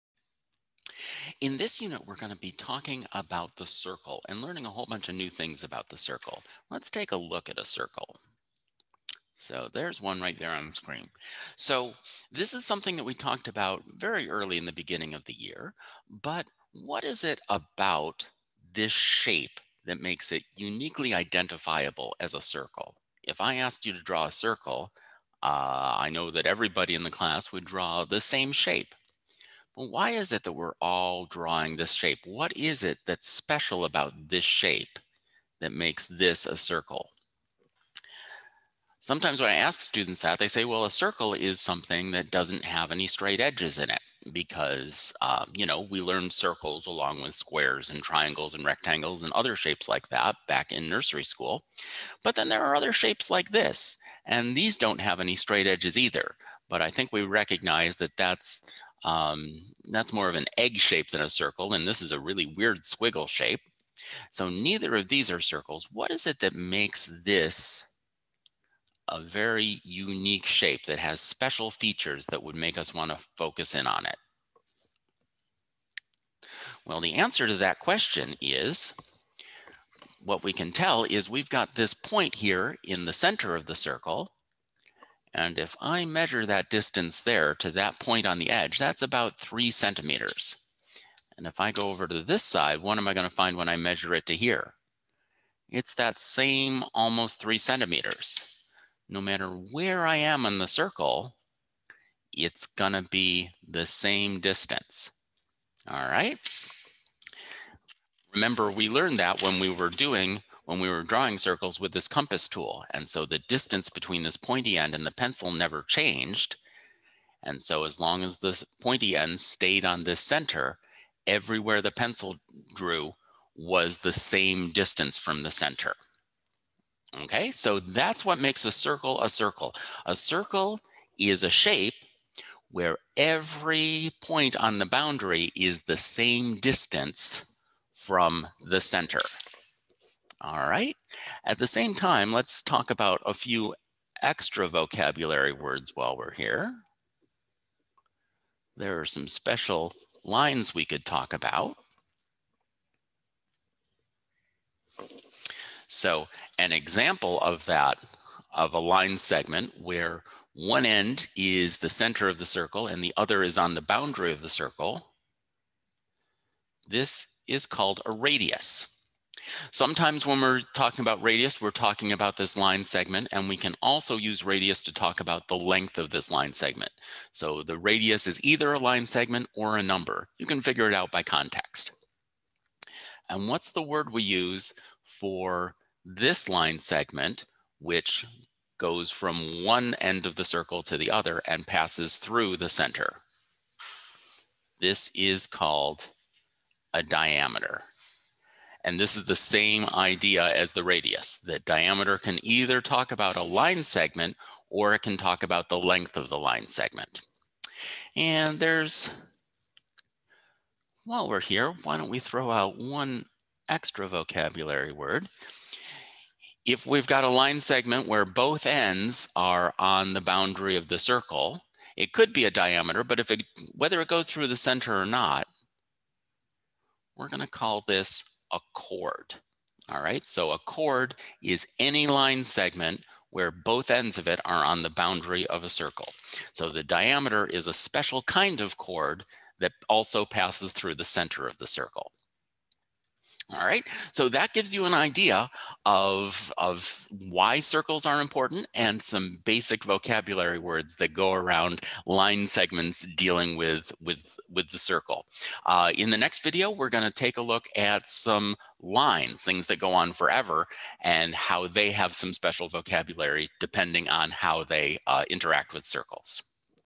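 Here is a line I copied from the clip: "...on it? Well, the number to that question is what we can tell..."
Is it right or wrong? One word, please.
wrong.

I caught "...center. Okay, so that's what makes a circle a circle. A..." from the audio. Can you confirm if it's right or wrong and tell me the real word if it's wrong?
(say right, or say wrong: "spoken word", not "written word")
right.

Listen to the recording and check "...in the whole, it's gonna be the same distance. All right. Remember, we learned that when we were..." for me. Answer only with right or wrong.
wrong.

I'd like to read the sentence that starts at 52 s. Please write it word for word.
But then there are other shapes like this, and these don't have any straight edges either.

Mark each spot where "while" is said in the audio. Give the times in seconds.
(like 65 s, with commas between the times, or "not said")
145 s, 211 s.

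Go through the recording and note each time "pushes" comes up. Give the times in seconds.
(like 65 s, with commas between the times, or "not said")
not said.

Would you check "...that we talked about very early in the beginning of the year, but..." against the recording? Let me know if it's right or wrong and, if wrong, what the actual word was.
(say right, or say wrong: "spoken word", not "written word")
right.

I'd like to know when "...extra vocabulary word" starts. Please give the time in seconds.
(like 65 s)
213 s.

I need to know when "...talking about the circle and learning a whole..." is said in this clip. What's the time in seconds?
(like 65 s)
2 s.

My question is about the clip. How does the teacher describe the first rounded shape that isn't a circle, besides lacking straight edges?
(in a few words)
egg shape.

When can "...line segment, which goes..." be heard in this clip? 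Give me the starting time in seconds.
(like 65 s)
186 s.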